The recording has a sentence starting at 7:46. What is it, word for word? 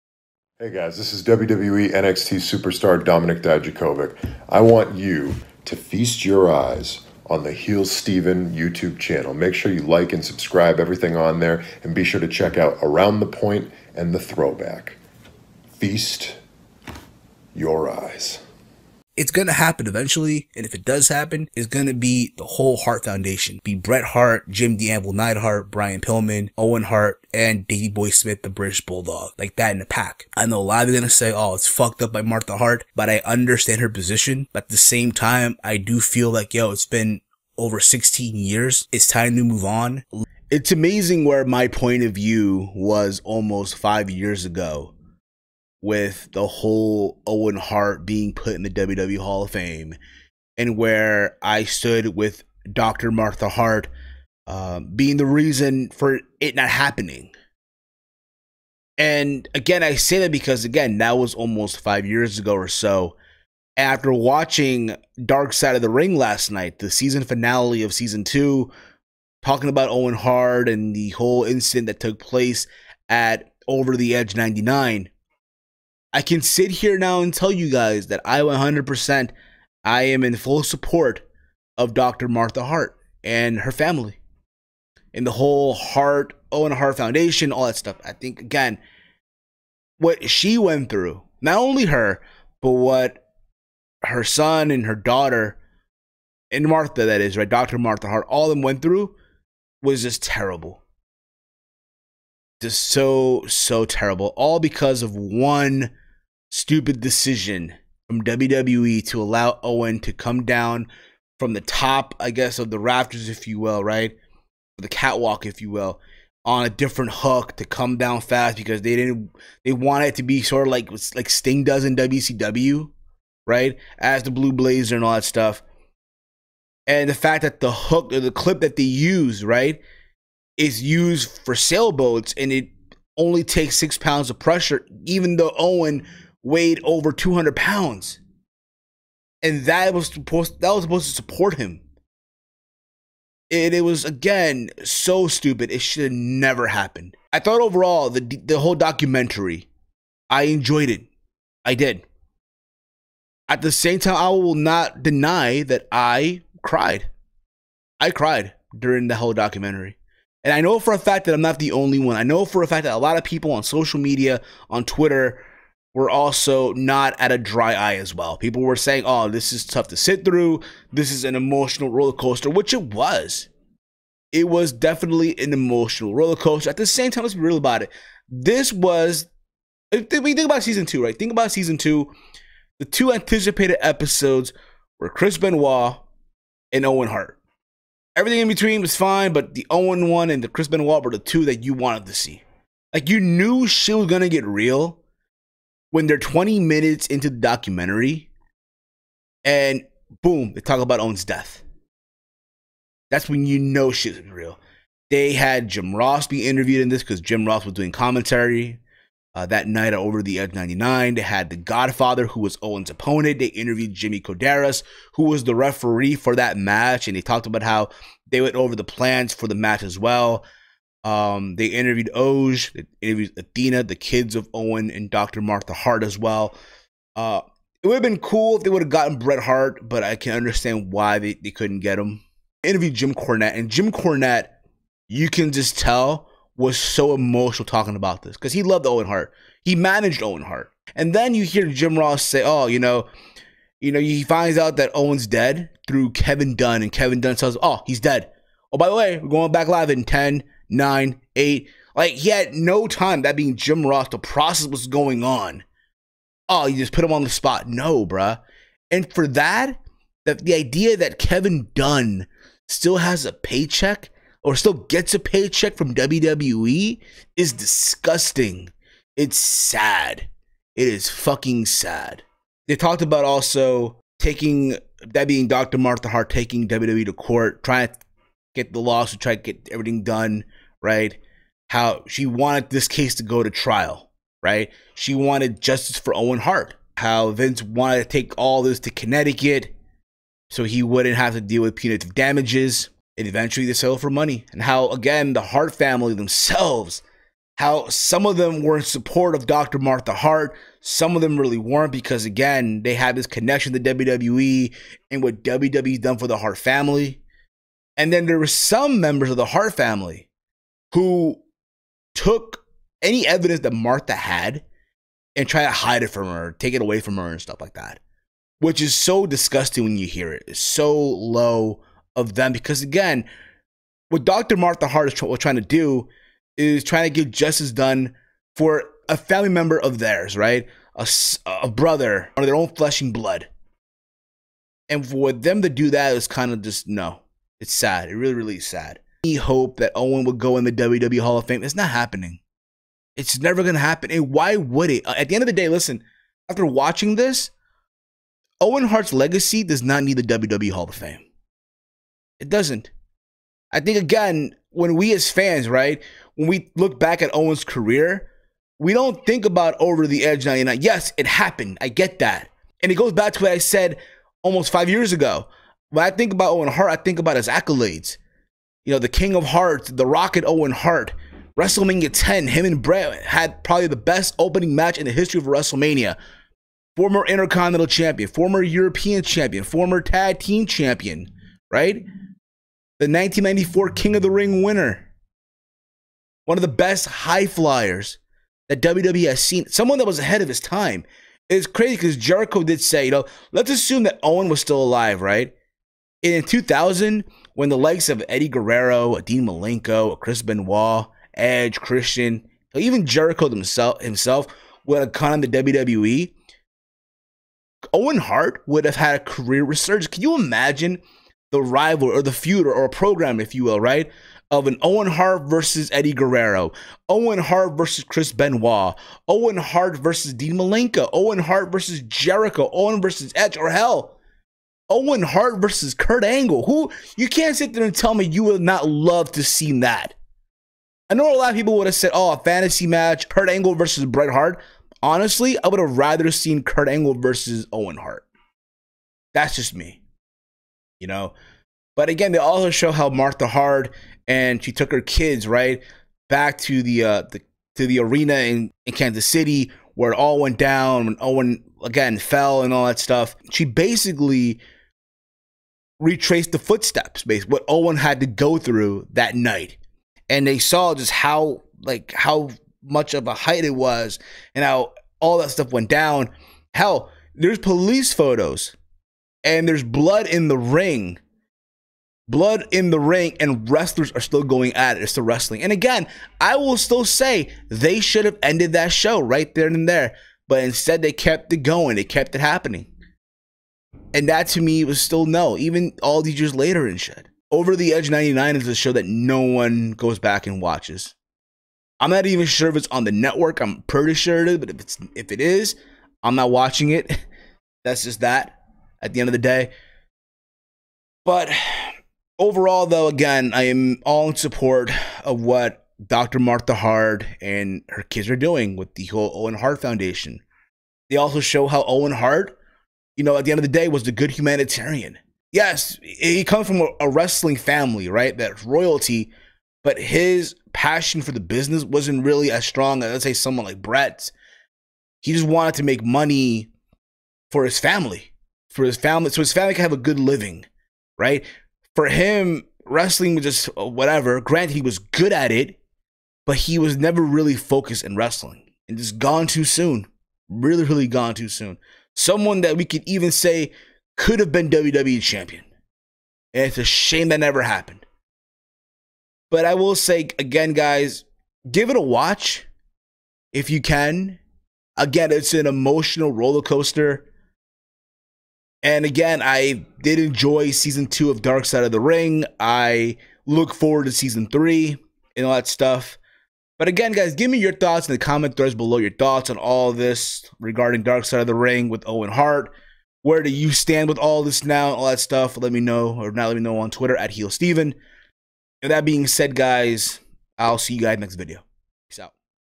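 Hell, there's police photos, and there's blood in the ring.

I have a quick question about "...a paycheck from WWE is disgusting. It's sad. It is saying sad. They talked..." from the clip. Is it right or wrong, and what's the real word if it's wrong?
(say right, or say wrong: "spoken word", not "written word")
wrong: "fucking", not "saying".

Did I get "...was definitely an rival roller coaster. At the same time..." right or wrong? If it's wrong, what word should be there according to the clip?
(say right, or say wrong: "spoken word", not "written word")
wrong: "emotional", not "rival".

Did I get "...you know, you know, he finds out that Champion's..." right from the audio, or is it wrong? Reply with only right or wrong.
wrong.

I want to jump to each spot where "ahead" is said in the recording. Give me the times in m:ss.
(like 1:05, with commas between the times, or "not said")
6:30.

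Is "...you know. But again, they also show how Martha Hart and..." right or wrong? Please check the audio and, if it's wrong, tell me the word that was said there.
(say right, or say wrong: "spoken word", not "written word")
right.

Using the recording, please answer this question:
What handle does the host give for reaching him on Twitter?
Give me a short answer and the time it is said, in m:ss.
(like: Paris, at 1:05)
HeelSteven, at 9:37.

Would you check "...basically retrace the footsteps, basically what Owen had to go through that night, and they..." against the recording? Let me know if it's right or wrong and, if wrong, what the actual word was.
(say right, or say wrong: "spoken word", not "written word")
right.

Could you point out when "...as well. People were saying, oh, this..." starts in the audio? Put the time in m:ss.
2:47.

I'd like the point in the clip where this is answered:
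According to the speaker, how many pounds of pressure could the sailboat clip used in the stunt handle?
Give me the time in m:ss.
2:13.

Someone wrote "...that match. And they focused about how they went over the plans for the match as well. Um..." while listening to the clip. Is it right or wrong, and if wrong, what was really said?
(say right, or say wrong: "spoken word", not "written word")
wrong: "talked", not "focused".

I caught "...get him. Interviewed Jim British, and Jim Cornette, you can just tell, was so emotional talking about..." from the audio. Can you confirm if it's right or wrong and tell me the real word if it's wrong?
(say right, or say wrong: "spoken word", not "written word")
wrong: "Cornette", not "British".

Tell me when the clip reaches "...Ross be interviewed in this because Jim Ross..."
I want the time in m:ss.
3:25.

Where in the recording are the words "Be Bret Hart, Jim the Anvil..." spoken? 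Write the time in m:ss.
0:23.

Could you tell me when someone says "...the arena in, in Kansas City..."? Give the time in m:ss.
7:27.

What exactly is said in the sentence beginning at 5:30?
A, a brother or their own flesh and blood.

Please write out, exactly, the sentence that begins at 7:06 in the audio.
Who you can't sit there and tell me you would not love to see that.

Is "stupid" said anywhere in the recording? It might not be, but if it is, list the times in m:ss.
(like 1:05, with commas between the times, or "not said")
1:46, 2:25.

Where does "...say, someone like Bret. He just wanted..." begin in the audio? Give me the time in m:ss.
8:43.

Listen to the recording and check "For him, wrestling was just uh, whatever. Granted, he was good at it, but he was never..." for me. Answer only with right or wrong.
right.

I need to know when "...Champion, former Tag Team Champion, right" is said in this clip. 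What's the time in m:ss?
6:19.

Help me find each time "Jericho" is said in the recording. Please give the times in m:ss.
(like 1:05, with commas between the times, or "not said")
6:32, 6:43, 7:02.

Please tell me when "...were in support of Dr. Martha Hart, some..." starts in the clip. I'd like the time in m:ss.
4:58.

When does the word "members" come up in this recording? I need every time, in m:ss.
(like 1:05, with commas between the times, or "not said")
5:08, 5:29.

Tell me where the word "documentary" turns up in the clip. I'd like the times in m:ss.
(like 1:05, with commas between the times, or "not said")
2:28, 2:39, 3:17.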